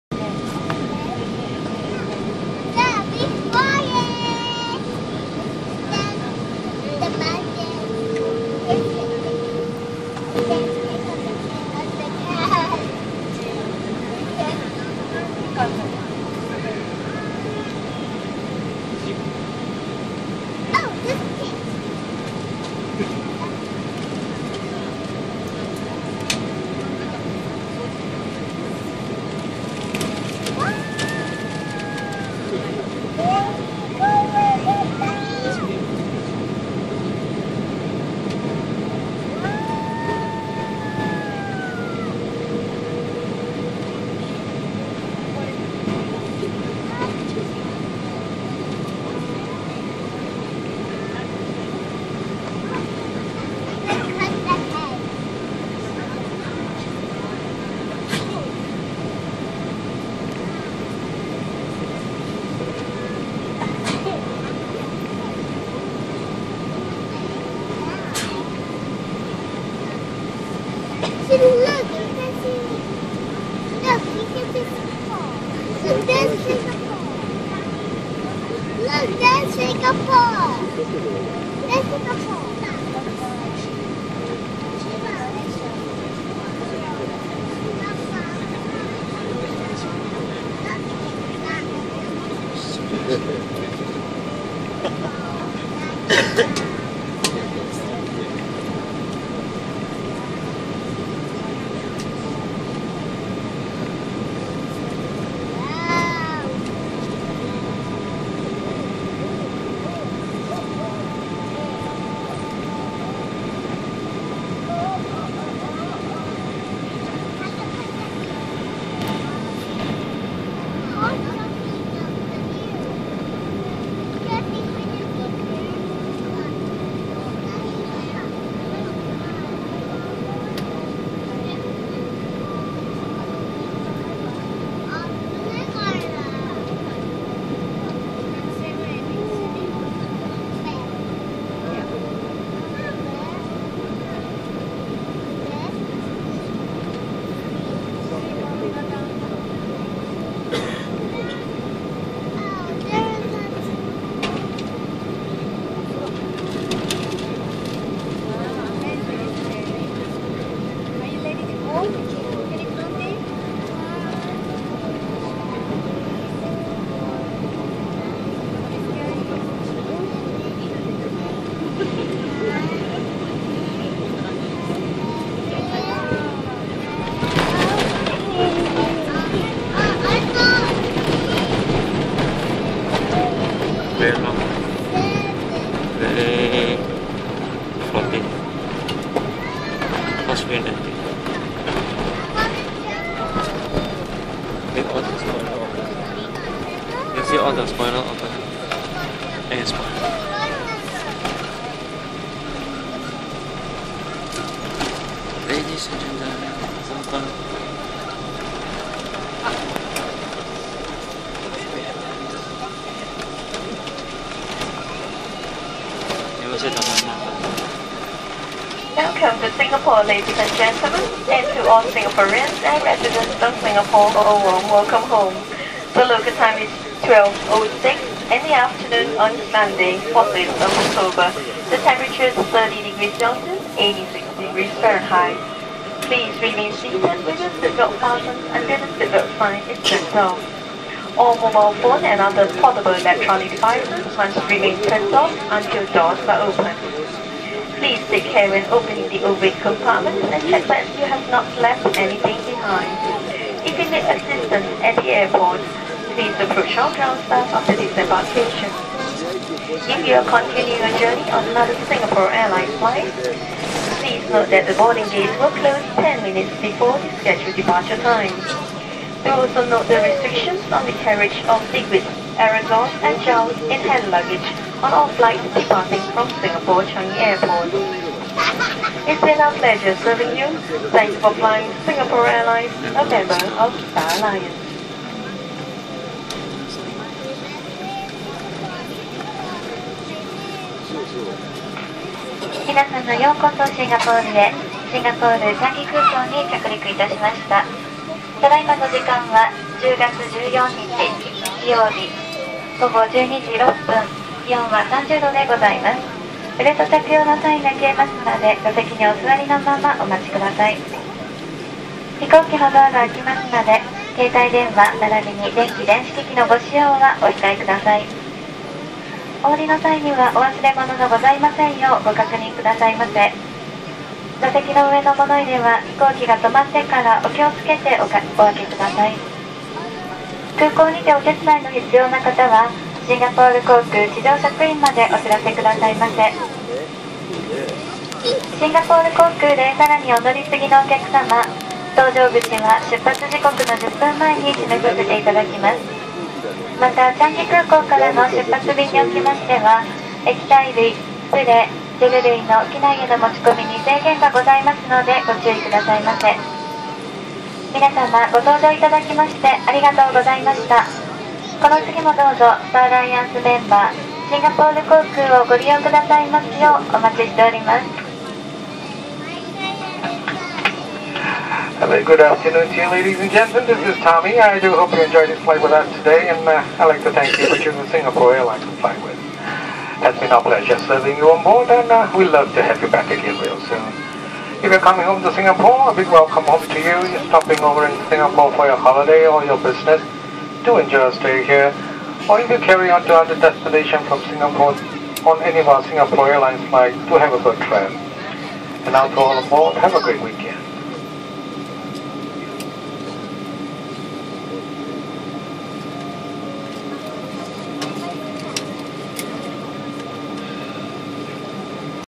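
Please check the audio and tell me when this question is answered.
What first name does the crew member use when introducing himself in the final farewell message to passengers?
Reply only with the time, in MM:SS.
06:14.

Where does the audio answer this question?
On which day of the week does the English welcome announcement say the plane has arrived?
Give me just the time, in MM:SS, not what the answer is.
03:49.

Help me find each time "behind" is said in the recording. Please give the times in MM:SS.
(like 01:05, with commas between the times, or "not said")
04:12.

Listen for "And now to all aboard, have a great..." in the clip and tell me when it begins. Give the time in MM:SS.
06:38.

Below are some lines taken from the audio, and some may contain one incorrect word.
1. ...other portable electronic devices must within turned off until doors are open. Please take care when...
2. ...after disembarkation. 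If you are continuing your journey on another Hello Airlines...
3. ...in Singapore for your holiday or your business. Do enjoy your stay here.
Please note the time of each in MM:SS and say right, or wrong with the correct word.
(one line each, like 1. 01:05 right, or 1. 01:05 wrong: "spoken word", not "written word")
1. 04:02 wrong: "remain", not "within"
2. 04:17 wrong: "Singapore", not "Hello"
3. 06:27 right.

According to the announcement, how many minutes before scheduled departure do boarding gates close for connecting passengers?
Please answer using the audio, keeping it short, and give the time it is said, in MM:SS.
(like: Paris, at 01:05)
10 minutes, at 04:26.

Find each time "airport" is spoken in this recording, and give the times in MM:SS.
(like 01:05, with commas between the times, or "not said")
04:15, 04:37.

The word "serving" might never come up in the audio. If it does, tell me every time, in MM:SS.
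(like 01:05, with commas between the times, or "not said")
04:40, 06:20.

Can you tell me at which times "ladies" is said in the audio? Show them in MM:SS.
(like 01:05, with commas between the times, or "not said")
03:17, 03:40, 06:12.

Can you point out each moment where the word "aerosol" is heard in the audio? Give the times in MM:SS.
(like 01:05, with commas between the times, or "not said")
04:32.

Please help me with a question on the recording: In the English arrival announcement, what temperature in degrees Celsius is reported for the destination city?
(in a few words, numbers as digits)
30 degrees Celsius.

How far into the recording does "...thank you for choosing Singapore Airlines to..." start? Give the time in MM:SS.
06:17.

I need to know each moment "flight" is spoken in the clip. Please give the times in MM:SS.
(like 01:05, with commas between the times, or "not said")
04:22, 04:35, 06:15, 06:36.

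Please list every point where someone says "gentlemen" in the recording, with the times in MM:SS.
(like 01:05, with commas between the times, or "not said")
03:17, 03:40, 06:13.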